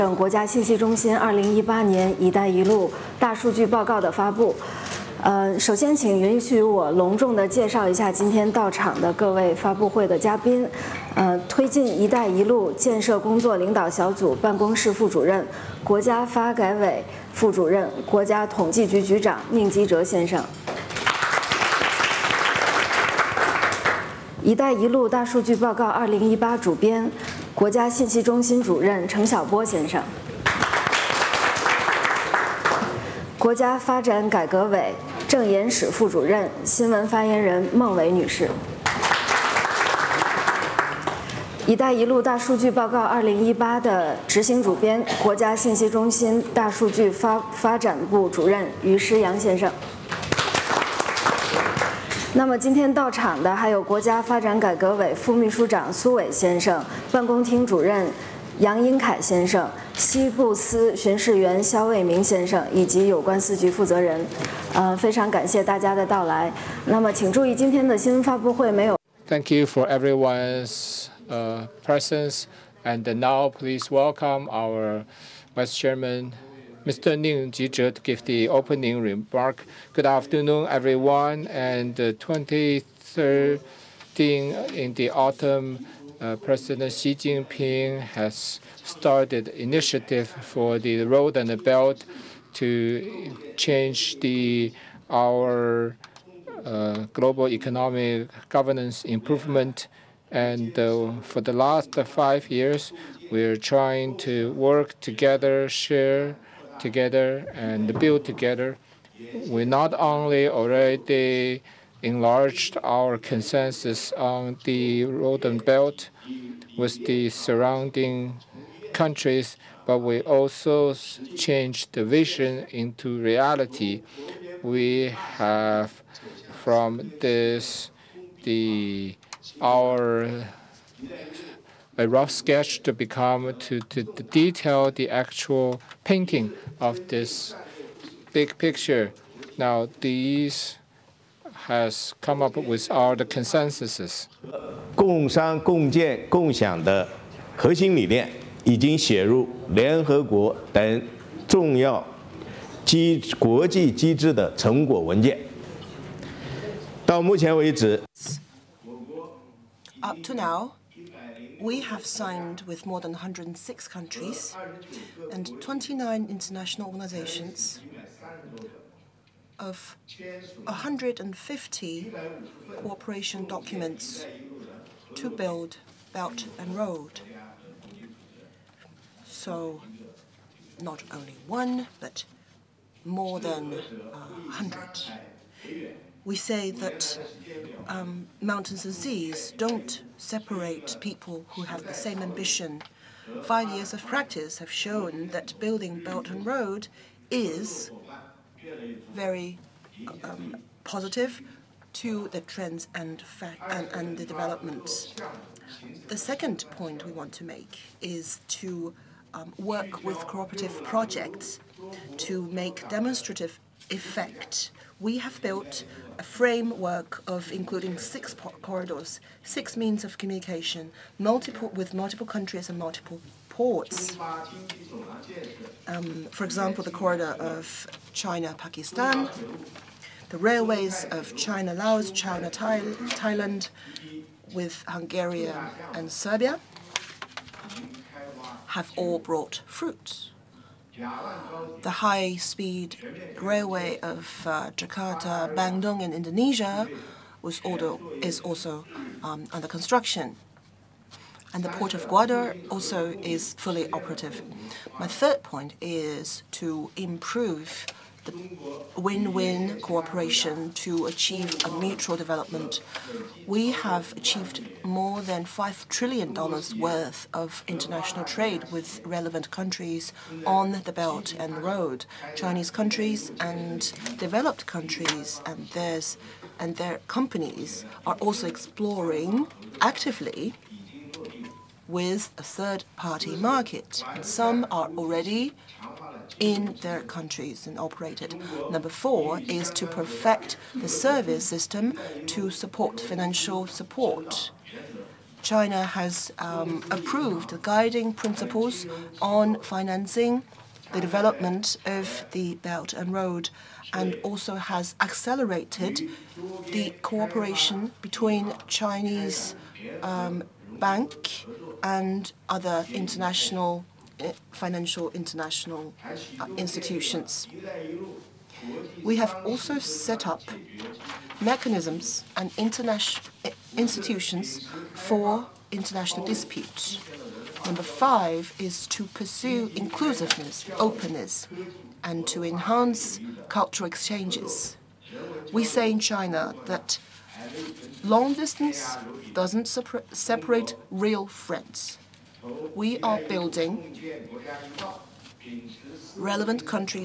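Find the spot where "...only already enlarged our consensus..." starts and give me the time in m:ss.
1:49.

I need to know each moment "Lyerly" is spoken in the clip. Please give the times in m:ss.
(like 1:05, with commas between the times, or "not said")
not said.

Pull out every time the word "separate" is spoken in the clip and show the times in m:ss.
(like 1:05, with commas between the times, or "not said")
3:10, 5:40.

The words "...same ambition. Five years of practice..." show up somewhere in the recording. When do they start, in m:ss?
3:11.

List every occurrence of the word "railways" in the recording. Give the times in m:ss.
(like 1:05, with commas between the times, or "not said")
3:50, 4:03.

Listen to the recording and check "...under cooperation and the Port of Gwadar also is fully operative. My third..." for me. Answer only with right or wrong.
wrong.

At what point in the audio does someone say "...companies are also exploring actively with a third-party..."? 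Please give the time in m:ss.
4:37.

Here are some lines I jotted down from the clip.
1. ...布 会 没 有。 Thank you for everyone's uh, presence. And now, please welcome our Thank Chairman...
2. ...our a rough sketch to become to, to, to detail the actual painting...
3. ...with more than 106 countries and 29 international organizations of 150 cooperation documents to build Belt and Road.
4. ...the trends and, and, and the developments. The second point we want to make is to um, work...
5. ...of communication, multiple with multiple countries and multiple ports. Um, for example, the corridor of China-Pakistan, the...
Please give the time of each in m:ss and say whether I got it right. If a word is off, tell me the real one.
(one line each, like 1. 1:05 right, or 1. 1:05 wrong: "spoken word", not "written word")
1. 1:08 wrong: "Vice", not "Thank"
2. 2:09 right
3. 2:42 right
4. 3:22 right
5. 3:40 right.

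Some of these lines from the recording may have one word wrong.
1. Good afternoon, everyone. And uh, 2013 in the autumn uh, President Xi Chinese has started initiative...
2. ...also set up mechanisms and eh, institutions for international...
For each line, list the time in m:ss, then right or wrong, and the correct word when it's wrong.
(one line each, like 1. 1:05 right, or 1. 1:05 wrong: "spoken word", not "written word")
1. 1:19 wrong: "Jinping", not "Chinese"
2. 5:19 right.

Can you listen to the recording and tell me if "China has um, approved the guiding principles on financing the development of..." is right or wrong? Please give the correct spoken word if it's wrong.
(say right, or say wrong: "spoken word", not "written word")
right.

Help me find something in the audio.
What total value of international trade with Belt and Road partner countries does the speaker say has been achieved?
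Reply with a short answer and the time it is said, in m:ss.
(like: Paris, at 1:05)
$5 trillion, at 4:25.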